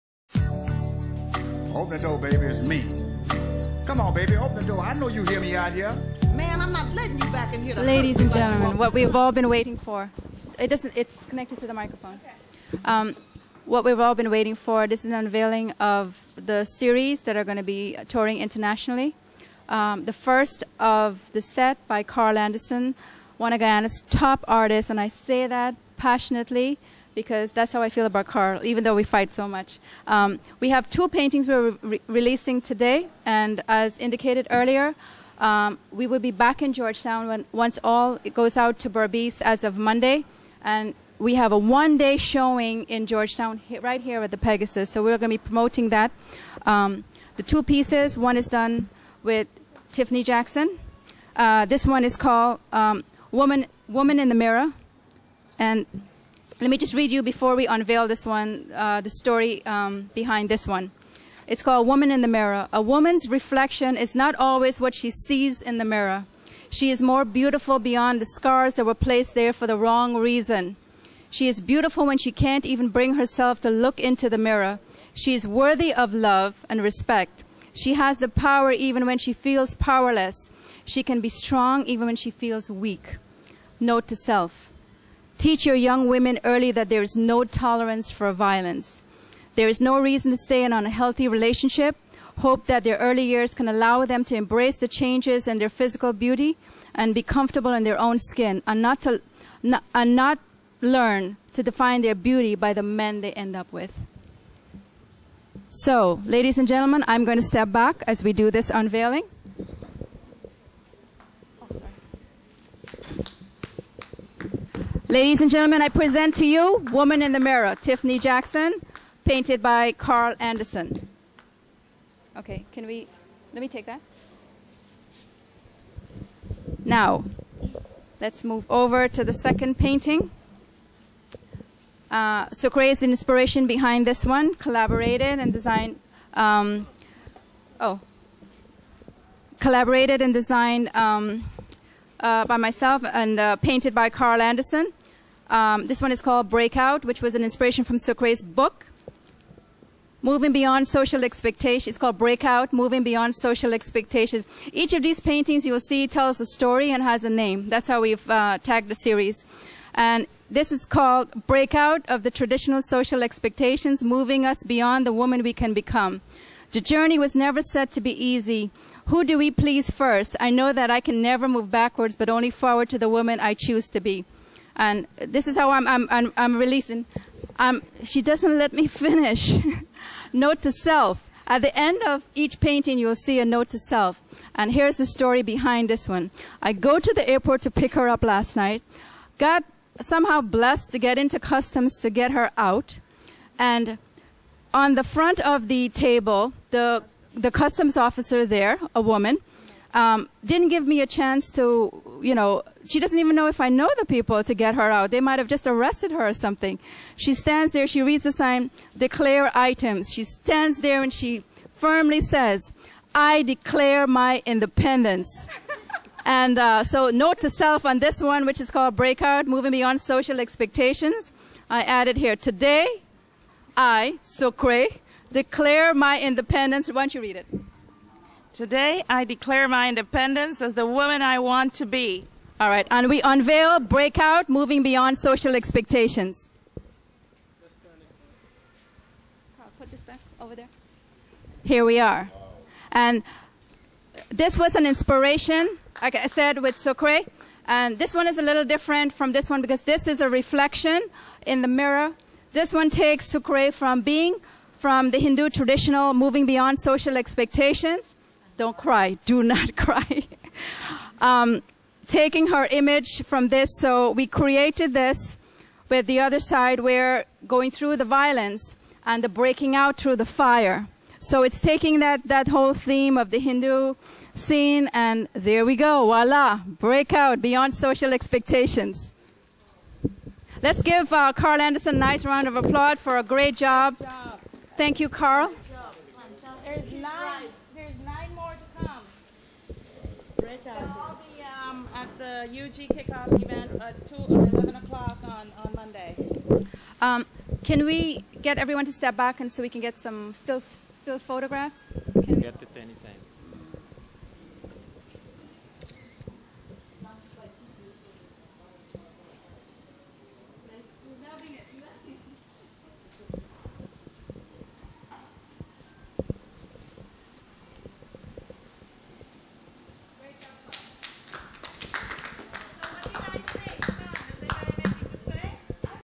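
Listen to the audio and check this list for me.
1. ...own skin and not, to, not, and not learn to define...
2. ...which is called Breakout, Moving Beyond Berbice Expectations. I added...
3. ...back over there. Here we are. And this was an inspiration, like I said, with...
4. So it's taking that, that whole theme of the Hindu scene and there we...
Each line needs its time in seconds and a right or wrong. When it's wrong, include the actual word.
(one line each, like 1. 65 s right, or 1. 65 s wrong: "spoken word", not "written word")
1. 97 s right
2. 218 s wrong: "Social", not "Berbice"
3. 240 s right
4. 271 s right.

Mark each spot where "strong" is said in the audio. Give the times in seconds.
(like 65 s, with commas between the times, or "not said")
81 s.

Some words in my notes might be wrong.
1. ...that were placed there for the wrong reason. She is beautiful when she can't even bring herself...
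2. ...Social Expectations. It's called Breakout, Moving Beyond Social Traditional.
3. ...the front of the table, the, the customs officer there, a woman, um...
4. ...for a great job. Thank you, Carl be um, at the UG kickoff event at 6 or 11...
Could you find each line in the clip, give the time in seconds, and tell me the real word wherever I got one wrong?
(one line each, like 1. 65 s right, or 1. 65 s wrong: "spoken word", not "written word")
1. 68 s right
2. 150 s wrong: "Expectations", not "Traditional"
3. 194 s right
4. 282 s wrong: "2", not "6".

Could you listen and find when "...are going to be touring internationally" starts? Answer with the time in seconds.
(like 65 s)
17 s.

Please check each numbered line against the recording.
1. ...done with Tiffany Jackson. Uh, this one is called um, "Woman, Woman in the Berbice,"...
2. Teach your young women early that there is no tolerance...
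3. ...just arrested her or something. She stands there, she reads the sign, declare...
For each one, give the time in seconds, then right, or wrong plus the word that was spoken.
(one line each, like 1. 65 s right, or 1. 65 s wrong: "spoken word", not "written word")
1. 48 s wrong: "Mirror", not "Berbice"
2. 85 s right
3. 205 s right.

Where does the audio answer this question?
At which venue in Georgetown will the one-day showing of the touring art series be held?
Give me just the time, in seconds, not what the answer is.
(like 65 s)
44 s.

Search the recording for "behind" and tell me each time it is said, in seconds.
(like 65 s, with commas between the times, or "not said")
60 s, 133 s, 185 s.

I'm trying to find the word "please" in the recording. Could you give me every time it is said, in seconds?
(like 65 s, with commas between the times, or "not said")
169 s.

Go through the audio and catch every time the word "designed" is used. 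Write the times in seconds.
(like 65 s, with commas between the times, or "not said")
135 s, 140 s.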